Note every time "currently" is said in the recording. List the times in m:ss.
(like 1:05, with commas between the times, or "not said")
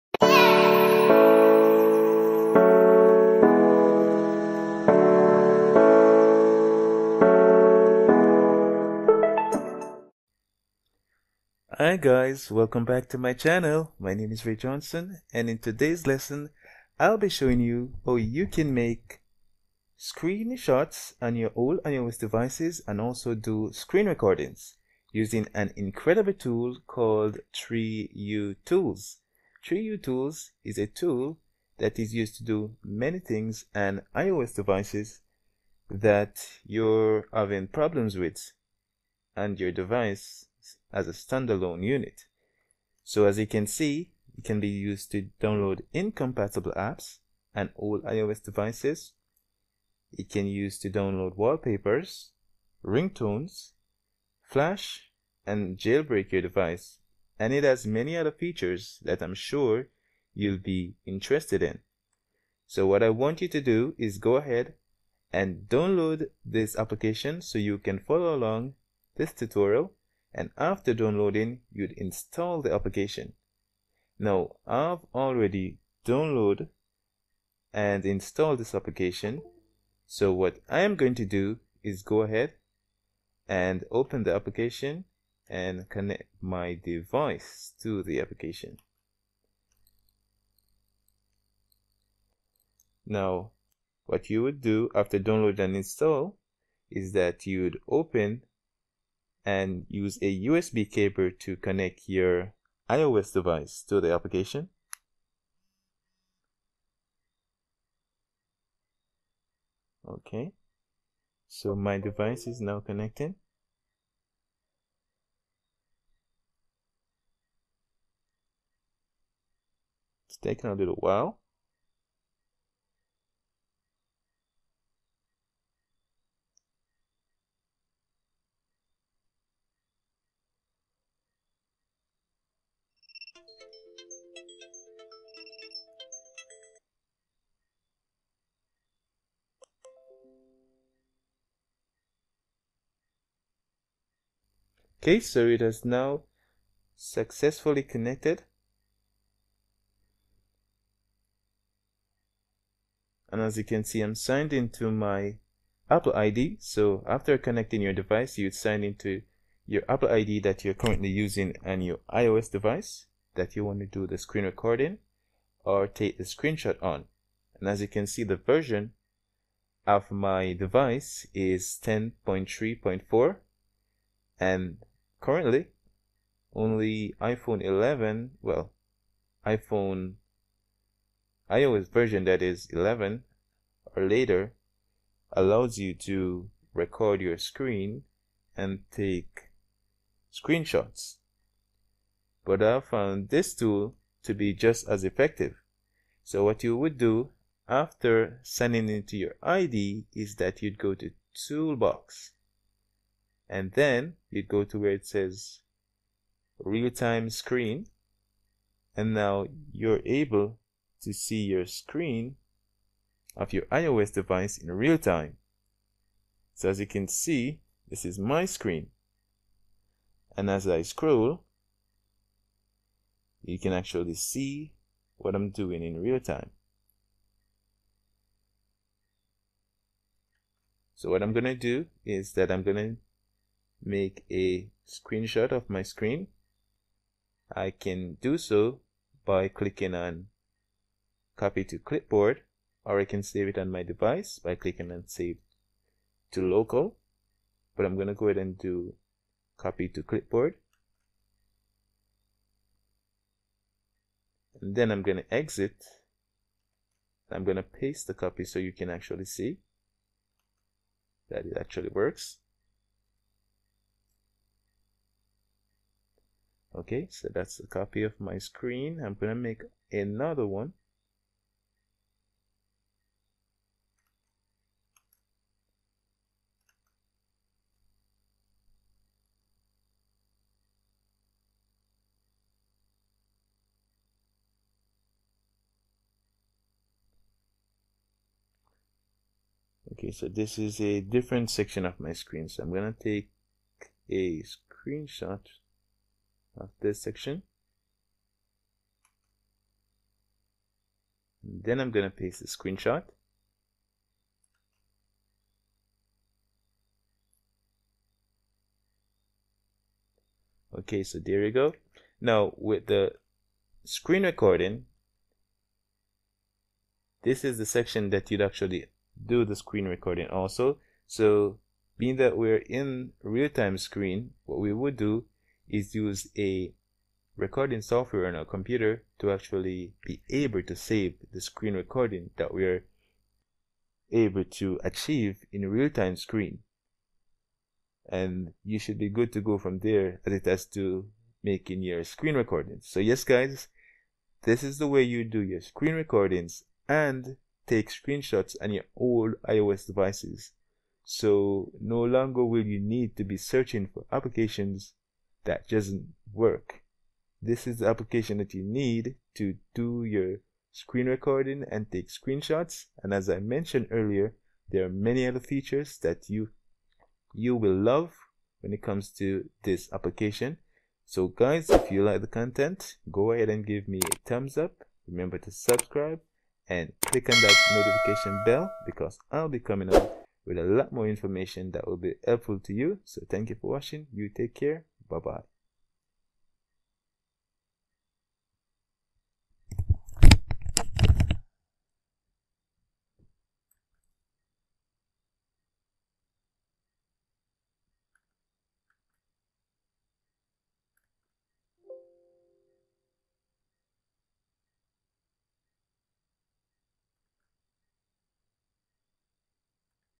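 2:40, 2:55.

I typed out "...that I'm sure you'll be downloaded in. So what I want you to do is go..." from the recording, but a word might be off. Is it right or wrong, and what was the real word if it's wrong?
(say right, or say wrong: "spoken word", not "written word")
wrong: "interested", not "downloaded".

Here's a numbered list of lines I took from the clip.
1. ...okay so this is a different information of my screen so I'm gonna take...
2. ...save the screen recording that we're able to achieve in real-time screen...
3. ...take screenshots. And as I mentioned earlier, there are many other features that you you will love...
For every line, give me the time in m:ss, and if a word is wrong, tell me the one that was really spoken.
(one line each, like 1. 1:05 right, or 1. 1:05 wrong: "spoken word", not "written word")
1. 4:49 wrong: "section", not "information"
2. 5:30 right
3. 6:01 right.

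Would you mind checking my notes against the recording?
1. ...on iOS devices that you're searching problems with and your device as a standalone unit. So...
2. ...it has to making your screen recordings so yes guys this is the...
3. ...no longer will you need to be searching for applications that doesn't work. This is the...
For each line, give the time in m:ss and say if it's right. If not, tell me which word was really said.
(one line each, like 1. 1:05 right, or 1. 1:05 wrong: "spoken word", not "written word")
1. 0:33 wrong: "having", not "searching"
2. 5:40 right
3. 5:51 right.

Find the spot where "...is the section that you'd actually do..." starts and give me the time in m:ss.
5:17.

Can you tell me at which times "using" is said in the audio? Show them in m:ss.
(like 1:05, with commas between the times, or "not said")
0:25, 2:41.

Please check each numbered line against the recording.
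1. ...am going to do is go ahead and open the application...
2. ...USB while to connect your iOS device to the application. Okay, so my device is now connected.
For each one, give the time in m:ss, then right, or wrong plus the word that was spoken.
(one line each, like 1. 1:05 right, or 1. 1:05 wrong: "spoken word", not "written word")
1. 1:20 right
2. 1:40 wrong: "cable", not "while".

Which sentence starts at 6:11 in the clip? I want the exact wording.
So guys, if you like the content, go ahead and give me a thumbs up.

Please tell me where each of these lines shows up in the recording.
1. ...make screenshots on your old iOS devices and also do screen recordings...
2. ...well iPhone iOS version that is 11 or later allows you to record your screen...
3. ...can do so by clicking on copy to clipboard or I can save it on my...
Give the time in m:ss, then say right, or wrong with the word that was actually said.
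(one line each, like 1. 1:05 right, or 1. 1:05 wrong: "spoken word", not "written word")
1. 0:18 right
2. 2:58 right
3. 3:57 right.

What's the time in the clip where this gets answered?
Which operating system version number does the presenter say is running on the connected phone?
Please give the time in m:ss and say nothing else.
2:51.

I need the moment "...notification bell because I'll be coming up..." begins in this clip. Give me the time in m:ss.
6:17.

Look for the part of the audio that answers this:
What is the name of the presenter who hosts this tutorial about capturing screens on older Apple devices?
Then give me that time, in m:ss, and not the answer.
0:14.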